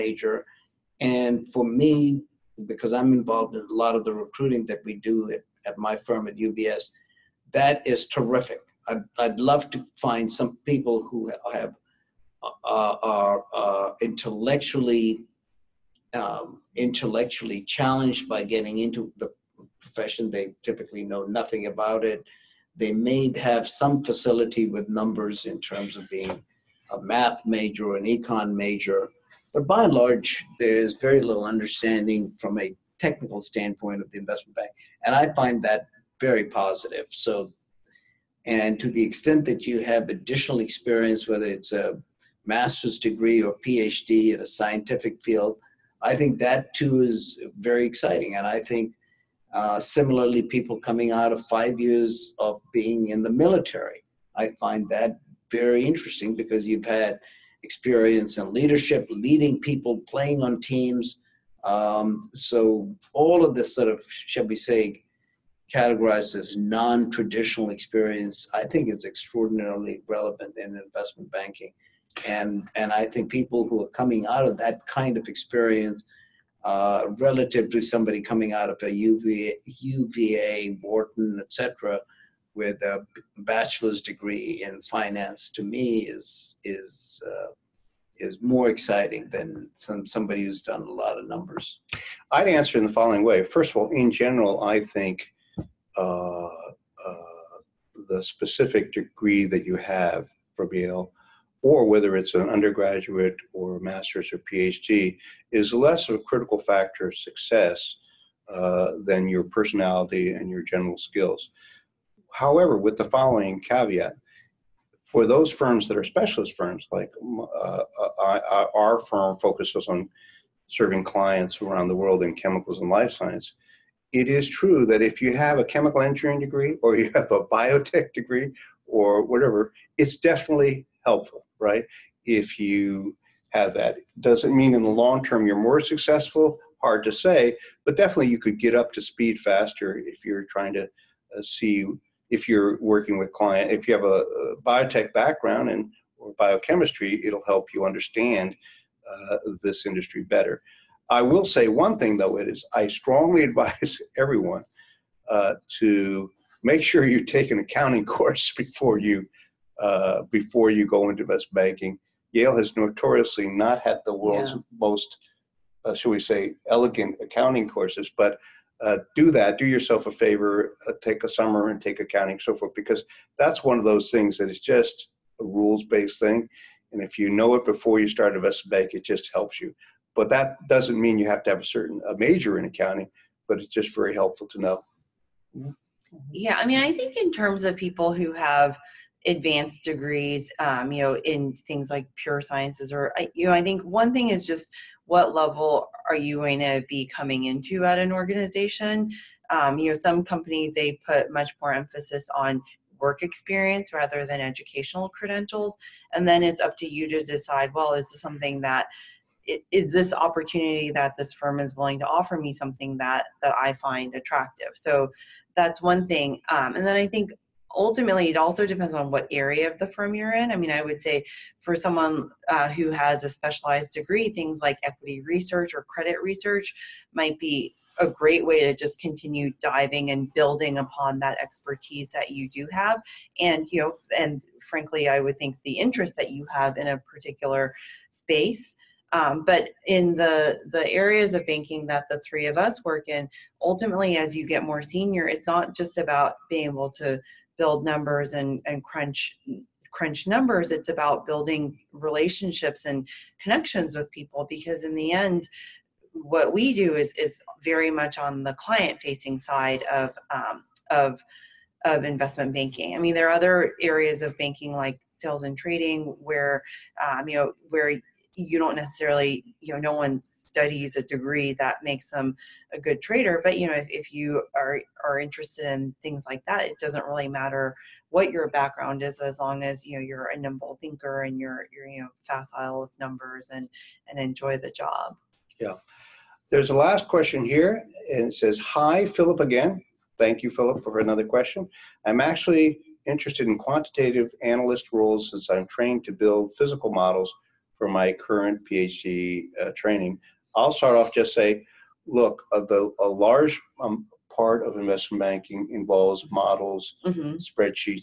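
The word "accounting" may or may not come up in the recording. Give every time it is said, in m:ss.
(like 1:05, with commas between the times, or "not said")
2:37, 2:47, 2:51, 3:02.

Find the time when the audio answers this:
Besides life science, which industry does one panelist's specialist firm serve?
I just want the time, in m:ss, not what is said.
2:02.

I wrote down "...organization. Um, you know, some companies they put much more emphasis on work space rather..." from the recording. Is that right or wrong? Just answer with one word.
wrong.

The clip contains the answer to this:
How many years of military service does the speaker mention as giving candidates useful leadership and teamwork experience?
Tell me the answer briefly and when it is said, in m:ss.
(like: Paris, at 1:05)
5, at 0:51.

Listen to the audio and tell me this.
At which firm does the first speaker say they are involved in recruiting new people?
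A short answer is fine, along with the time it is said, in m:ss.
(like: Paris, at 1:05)
UBS, at 0:06.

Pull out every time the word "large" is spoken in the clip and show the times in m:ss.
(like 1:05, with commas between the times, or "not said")
0:29, 5:03.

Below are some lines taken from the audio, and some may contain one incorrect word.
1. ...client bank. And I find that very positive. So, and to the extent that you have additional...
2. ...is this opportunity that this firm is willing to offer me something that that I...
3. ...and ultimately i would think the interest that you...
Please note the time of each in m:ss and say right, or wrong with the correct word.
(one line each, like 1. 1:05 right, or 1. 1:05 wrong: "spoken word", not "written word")
1. 0:34 wrong: "investment", not "client"
2. 3:29 right
3. 3:54 wrong: "frankly", not "ultimately".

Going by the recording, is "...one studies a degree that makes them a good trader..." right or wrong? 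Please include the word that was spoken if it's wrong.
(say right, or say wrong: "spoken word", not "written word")
right.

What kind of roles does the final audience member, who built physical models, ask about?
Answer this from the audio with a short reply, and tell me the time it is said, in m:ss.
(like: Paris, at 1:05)
quantitative analyst roles, at 4:53.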